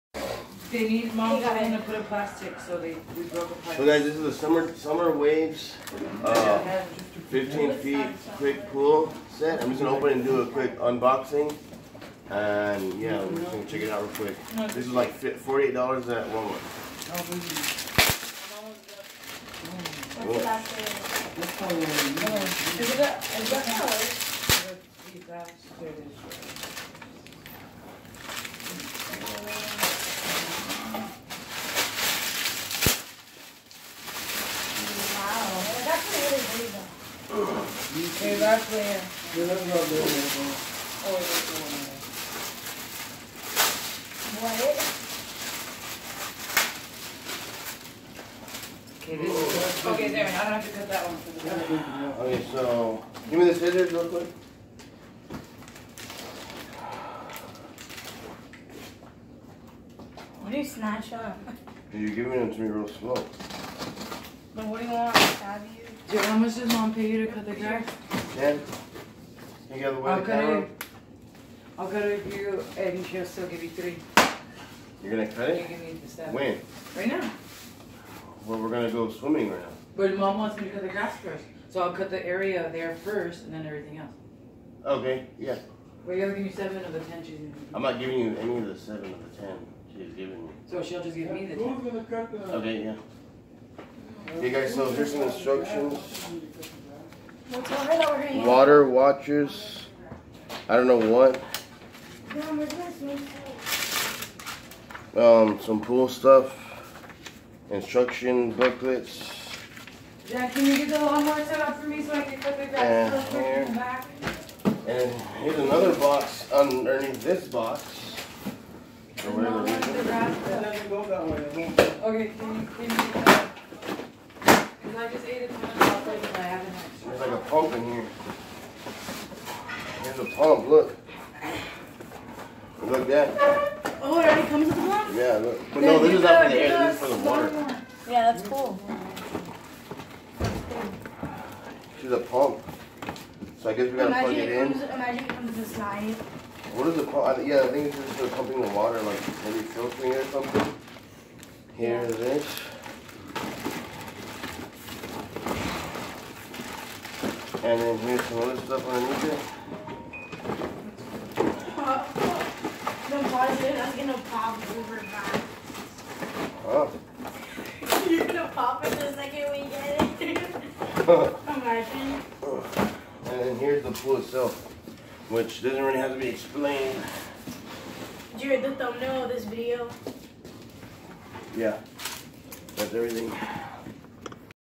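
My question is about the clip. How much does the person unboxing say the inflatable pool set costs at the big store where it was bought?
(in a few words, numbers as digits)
$48.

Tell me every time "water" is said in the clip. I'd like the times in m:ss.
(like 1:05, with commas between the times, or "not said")
1:38, 2:17, 2:28.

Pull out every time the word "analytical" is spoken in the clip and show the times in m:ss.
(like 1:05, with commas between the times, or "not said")
not said.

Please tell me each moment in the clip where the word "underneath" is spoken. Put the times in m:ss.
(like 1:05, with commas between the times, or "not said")
1:56, 2:38.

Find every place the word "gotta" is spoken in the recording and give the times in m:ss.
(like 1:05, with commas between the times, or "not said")
1:26, 2:23.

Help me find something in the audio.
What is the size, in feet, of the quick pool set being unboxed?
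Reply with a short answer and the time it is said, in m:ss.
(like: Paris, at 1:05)
15 feet, at 0:07.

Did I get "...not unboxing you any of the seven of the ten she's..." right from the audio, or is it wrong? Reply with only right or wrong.
wrong.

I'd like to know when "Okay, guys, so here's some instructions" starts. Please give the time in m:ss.
1:34.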